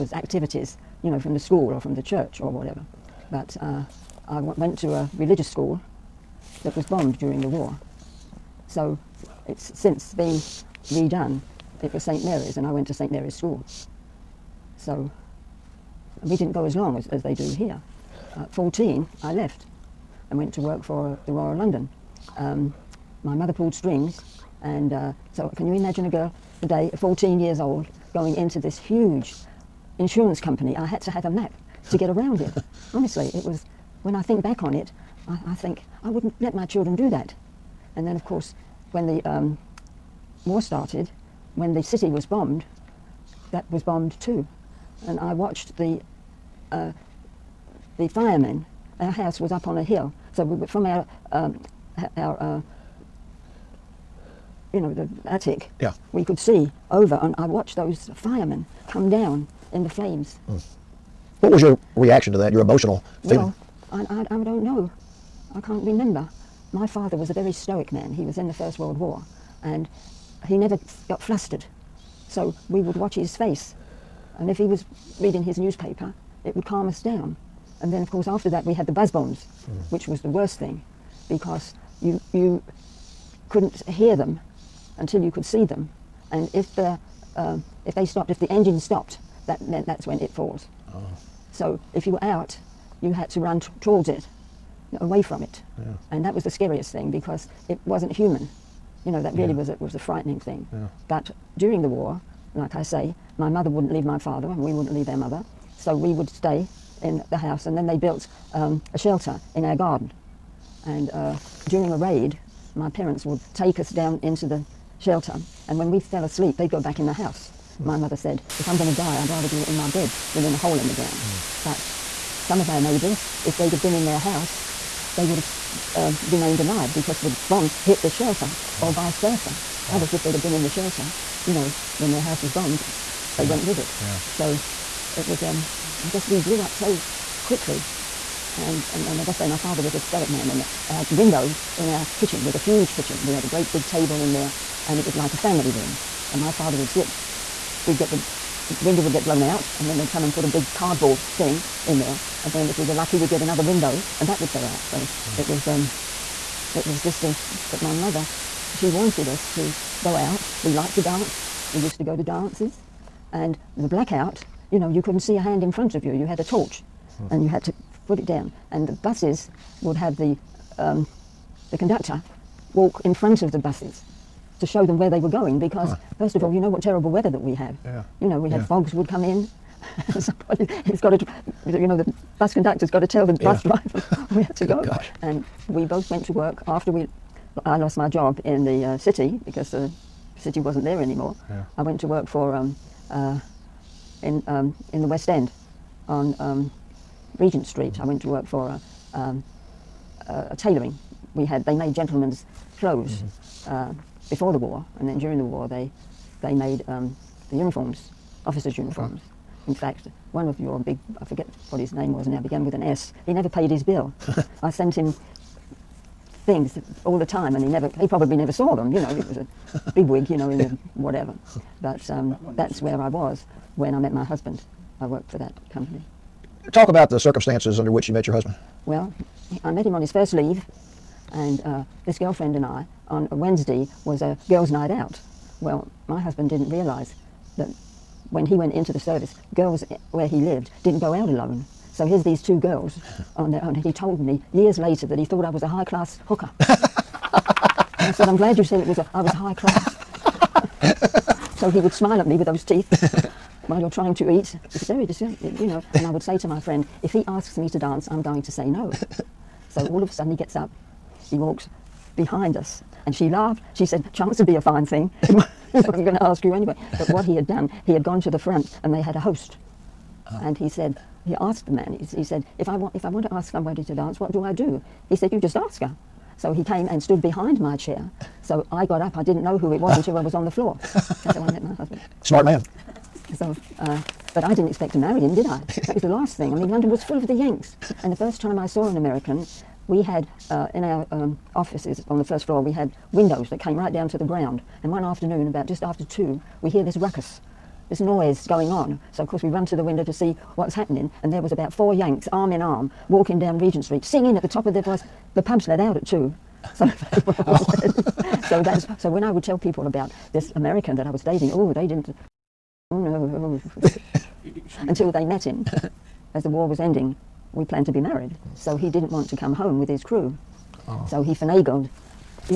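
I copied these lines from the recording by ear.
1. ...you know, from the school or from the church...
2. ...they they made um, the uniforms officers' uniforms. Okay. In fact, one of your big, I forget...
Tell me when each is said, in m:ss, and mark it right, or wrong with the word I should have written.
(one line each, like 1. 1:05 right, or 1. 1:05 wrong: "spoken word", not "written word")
1. 0:01 right
2. 3:25 right.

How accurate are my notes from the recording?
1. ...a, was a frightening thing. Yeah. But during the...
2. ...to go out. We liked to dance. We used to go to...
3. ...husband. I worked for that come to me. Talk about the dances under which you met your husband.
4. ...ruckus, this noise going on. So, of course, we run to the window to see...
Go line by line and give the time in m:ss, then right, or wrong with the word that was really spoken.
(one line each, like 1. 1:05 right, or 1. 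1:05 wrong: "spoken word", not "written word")
1. 1:39 right
2. 2:39 right
3. 3:44 wrong: "circumstances", not "dances"
4. 4:56 right.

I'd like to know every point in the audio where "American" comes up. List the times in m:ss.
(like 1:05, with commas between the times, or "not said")
4:48, 5:10.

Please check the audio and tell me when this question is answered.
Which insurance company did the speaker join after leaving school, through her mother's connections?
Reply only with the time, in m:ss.
0:21.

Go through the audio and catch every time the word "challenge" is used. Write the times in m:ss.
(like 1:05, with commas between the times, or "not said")
not said.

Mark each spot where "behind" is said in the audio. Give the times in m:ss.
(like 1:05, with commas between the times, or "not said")
4:22, 4:37.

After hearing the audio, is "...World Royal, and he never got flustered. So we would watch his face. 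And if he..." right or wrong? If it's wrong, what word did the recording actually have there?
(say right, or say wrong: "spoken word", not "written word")
wrong: "War", not "Royal".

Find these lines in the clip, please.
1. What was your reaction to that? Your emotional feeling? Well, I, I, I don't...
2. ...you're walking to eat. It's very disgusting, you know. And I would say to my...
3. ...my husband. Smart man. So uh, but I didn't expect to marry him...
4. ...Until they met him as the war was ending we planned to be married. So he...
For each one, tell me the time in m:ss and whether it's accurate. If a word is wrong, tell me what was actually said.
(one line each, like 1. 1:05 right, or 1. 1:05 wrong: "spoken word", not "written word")
1. 1:01 right
2. 4:13 wrong: "trying", not "walking"
3. 4:41 right
4. 5:14 right.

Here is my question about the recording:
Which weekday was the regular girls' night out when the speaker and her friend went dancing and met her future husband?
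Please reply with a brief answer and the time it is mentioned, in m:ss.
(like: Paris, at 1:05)
Wednesday, at 3:53.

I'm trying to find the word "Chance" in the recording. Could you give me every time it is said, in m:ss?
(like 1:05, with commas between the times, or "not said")
4:24.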